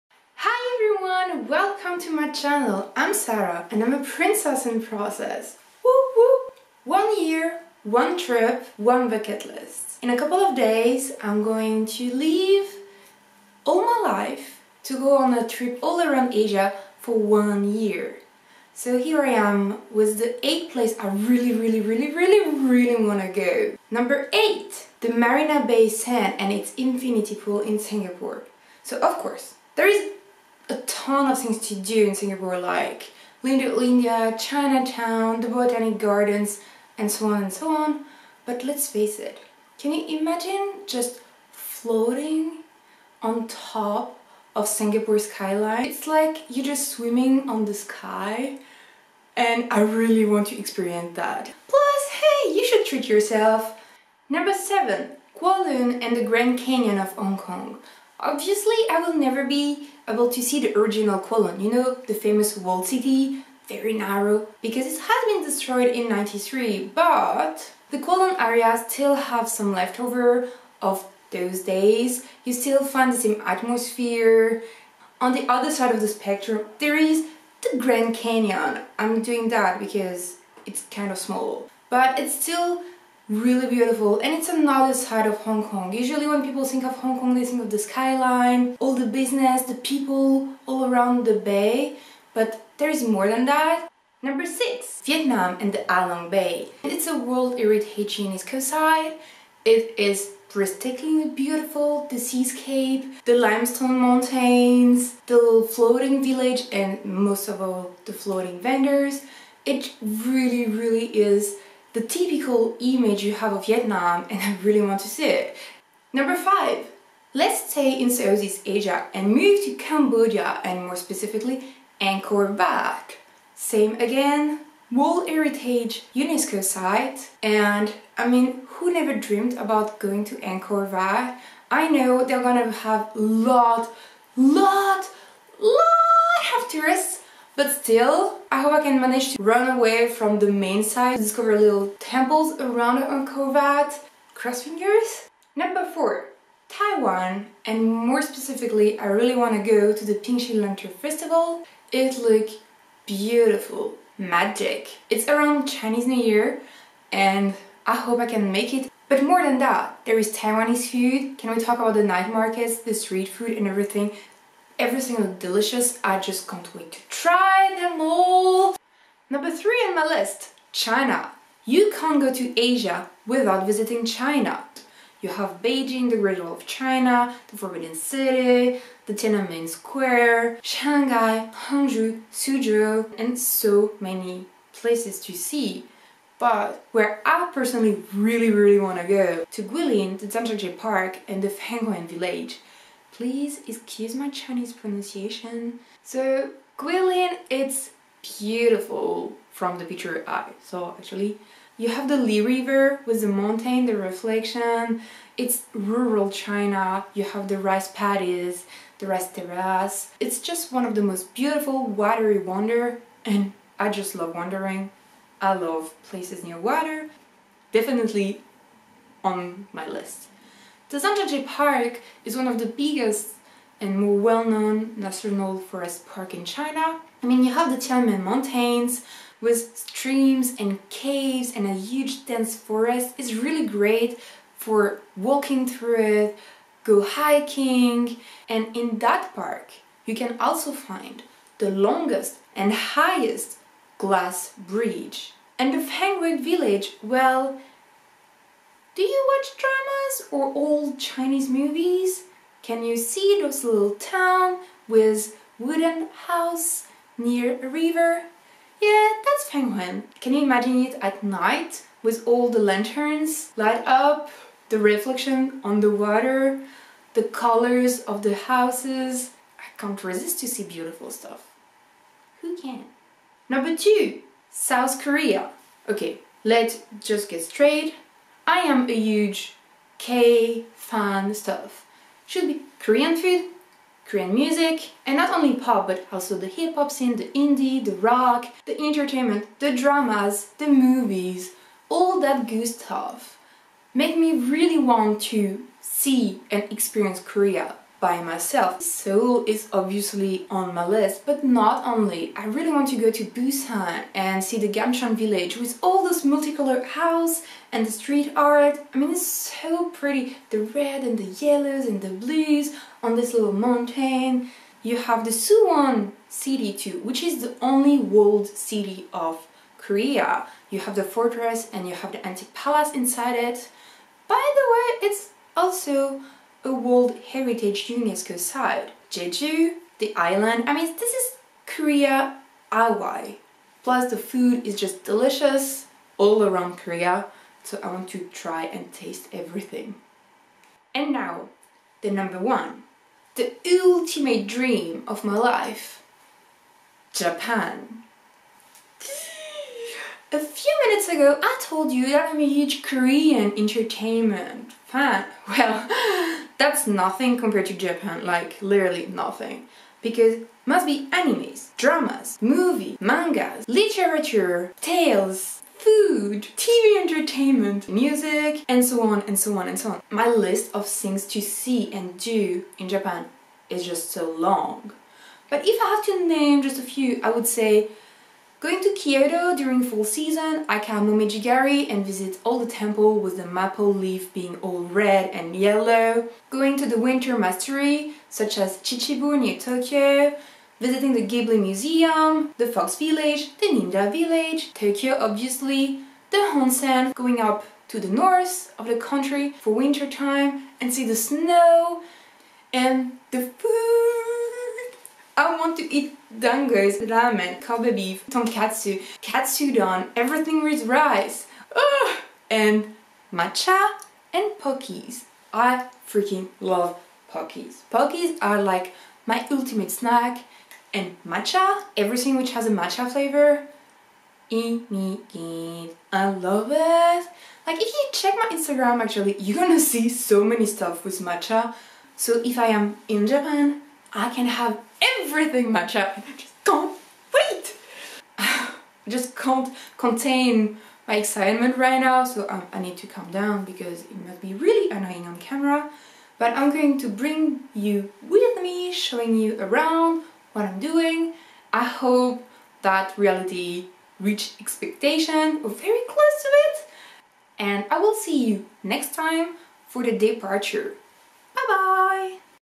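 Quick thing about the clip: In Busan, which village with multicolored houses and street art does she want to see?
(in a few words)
Gamcheon village.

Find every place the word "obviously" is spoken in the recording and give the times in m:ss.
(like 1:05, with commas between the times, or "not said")
0:58, 4:59, 6:35.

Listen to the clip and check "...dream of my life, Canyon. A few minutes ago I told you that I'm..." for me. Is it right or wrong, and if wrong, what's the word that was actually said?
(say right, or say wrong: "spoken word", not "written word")
wrong: "Japan", not "Canyon".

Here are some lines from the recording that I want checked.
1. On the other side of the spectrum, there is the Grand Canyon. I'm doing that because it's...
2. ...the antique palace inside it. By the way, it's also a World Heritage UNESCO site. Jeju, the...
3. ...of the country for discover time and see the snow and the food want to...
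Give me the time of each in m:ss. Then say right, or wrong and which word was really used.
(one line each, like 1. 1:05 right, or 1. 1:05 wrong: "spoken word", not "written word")
1. 1:15 right
2. 5:22 right
3. 6:38 wrong: "winter", not "discover".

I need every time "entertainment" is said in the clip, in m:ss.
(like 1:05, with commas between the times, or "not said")
4:48, 5:53, 6:07.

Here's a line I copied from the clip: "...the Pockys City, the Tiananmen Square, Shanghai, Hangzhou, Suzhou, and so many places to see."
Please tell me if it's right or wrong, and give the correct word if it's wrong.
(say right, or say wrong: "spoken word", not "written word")
wrong: "Forbidden", not "Pockys".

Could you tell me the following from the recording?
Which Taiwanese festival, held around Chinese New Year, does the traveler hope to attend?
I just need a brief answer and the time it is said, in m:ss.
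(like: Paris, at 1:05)
Pingxi Lantern Festival, at 2:30.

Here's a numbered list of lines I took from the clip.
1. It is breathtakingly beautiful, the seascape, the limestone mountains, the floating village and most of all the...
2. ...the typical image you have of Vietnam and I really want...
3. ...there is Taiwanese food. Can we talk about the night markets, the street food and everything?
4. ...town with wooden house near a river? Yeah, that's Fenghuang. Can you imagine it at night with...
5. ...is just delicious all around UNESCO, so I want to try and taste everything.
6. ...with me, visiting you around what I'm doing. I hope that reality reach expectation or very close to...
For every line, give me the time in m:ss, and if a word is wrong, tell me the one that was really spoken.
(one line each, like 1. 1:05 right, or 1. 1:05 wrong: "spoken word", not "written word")
1. 1:39 right
2. 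1:51 right
3. 2:40 right
4. 4:13 right
5. 5:34 wrong: "Korea", not "UNESCO"
6. 7:28 wrong: "showing", not "visiting".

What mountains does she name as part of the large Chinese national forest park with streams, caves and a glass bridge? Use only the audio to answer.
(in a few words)
Tianmen Mountains.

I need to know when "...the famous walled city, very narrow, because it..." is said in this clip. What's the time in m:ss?
1:02.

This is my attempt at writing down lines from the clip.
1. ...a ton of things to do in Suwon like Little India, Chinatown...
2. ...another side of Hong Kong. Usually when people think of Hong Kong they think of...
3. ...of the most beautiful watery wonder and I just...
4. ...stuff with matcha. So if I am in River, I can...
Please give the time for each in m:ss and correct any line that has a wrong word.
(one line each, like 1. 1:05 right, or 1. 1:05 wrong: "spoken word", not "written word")
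1. 0:30 wrong: "Singapore", not "Suwon"
2. 1:24 right
3. 3:30 right
4. 7:10 wrong: "Japan", not "River".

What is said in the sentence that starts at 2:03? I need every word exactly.
Same again, World Heritage UNESCO site and I mean who never dreamed about going to Angkor Wat?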